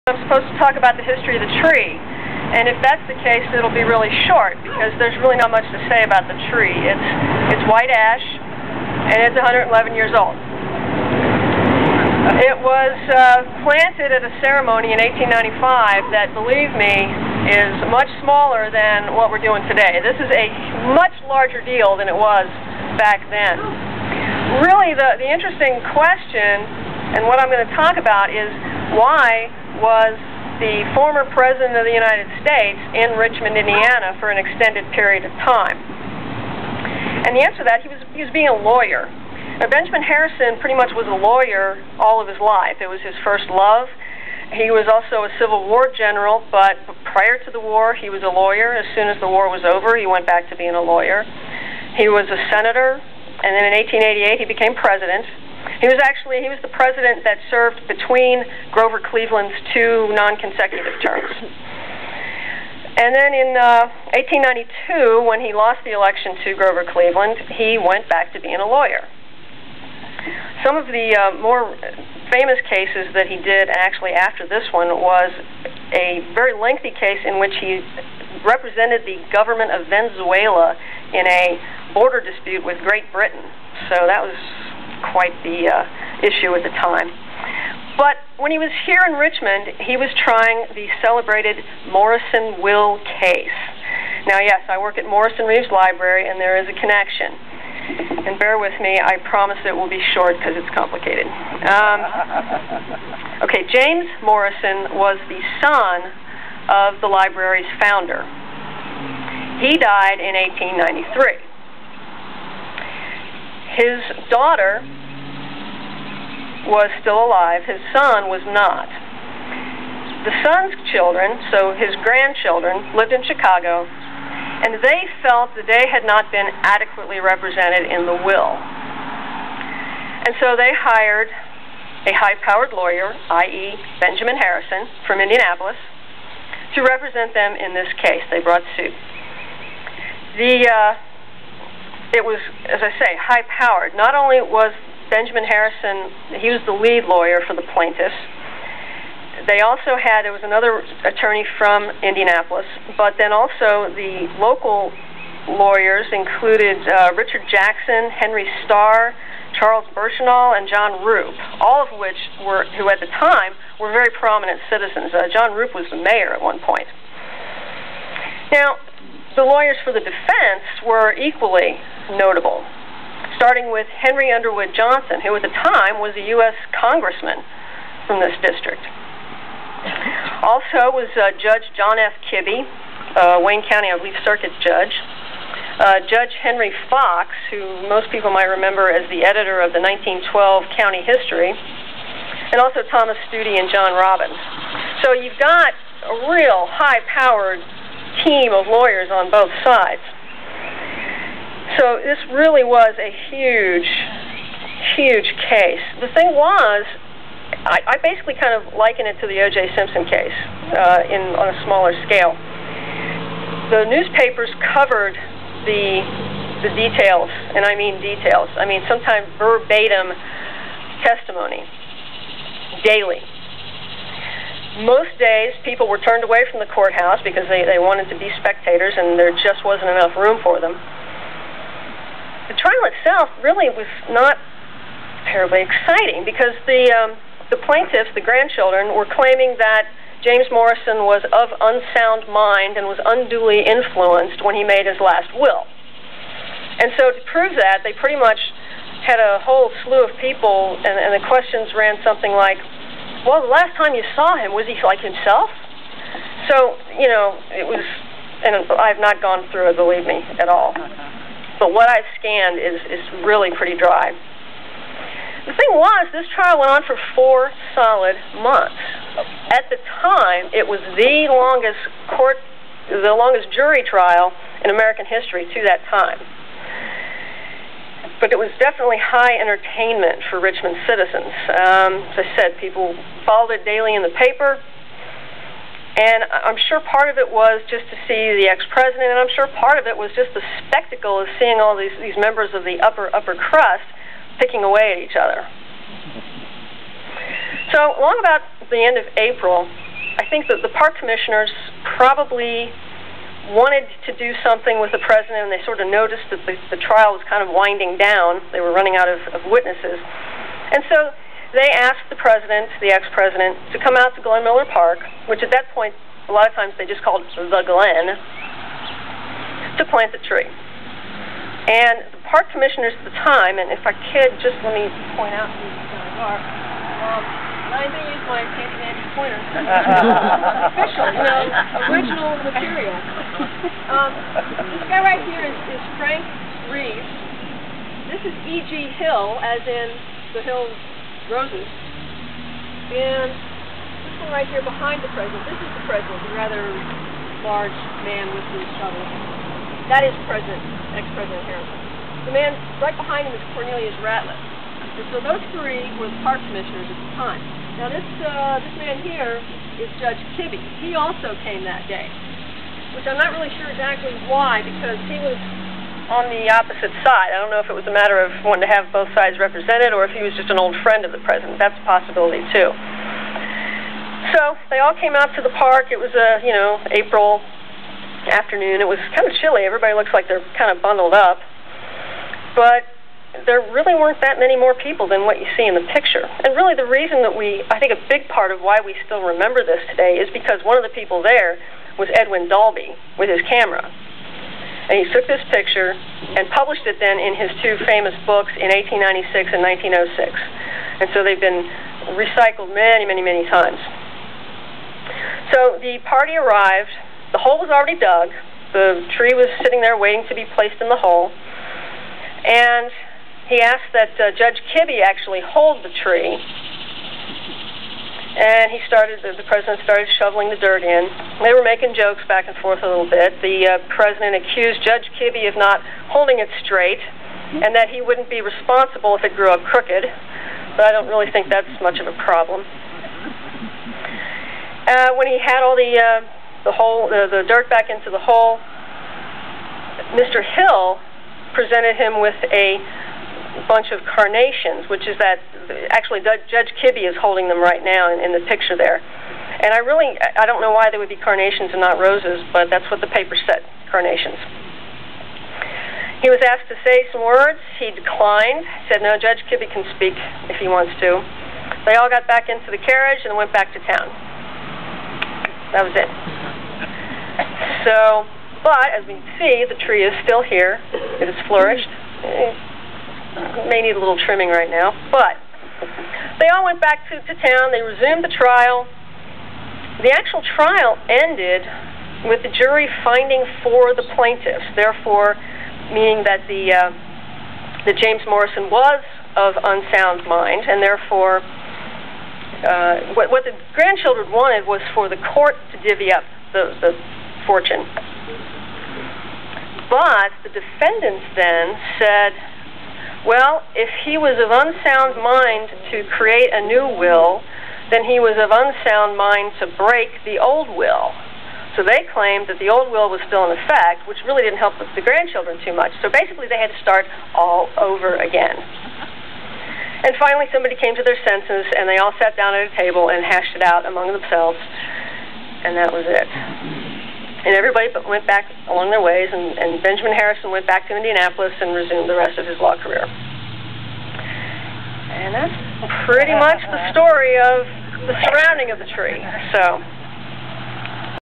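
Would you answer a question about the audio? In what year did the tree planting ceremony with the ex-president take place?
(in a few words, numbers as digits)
1895.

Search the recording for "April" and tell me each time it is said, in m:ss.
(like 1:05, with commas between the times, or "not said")
4:59, 6:16.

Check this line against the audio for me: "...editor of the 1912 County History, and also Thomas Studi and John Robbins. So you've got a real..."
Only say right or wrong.
right.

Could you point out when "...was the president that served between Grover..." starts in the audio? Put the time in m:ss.
0:56.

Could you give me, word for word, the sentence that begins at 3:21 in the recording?
So this really was a huge, huge case.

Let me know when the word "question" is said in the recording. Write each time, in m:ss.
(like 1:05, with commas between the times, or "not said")
0:25, 4:11.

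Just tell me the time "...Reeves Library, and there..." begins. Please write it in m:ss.
1:35.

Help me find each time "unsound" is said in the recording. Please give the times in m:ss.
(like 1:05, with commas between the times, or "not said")
4:01, 8:09, 8:24, 8:28.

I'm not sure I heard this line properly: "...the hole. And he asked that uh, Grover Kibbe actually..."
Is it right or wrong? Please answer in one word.
wrong.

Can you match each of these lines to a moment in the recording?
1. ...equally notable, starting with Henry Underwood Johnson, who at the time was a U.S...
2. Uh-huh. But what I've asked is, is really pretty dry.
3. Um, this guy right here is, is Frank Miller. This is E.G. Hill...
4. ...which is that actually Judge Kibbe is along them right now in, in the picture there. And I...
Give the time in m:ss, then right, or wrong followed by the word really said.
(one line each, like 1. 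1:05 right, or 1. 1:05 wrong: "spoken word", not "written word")
1. 2:51 right
2. 4:20 wrong: "scanned", not "asked"
3. 5:33 wrong: "Reeves", not "Miller"
4. 7:24 wrong: "holding", not "along".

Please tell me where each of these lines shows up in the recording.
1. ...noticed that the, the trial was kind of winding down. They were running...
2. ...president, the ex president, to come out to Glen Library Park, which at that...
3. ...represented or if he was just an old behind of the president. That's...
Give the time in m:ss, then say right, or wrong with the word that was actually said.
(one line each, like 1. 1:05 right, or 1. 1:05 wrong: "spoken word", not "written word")
1. 5:05 right
2. 5:12 wrong: "Miller", not "Library"
3. 6:09 wrong: "friend", not "behind".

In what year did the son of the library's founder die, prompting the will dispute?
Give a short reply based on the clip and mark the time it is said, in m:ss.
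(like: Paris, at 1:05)
1893, at 1:50.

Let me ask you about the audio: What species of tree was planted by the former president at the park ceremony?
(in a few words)
White ash.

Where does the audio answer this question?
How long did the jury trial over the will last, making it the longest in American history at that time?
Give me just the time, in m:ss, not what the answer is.
4:27.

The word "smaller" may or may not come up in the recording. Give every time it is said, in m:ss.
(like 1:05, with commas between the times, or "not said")
0:18, 3:31.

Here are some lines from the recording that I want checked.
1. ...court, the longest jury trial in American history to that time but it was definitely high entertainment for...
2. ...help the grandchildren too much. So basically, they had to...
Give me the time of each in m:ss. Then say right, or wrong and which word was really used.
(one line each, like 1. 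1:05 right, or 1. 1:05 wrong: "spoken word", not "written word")
1. 4:32 right
2. 8:34 right.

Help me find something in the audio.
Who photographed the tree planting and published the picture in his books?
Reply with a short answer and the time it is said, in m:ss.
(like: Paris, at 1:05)
Edwin Dalbey, at 6:32.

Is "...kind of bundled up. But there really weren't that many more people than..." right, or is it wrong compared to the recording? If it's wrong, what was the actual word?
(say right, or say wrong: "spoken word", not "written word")
right.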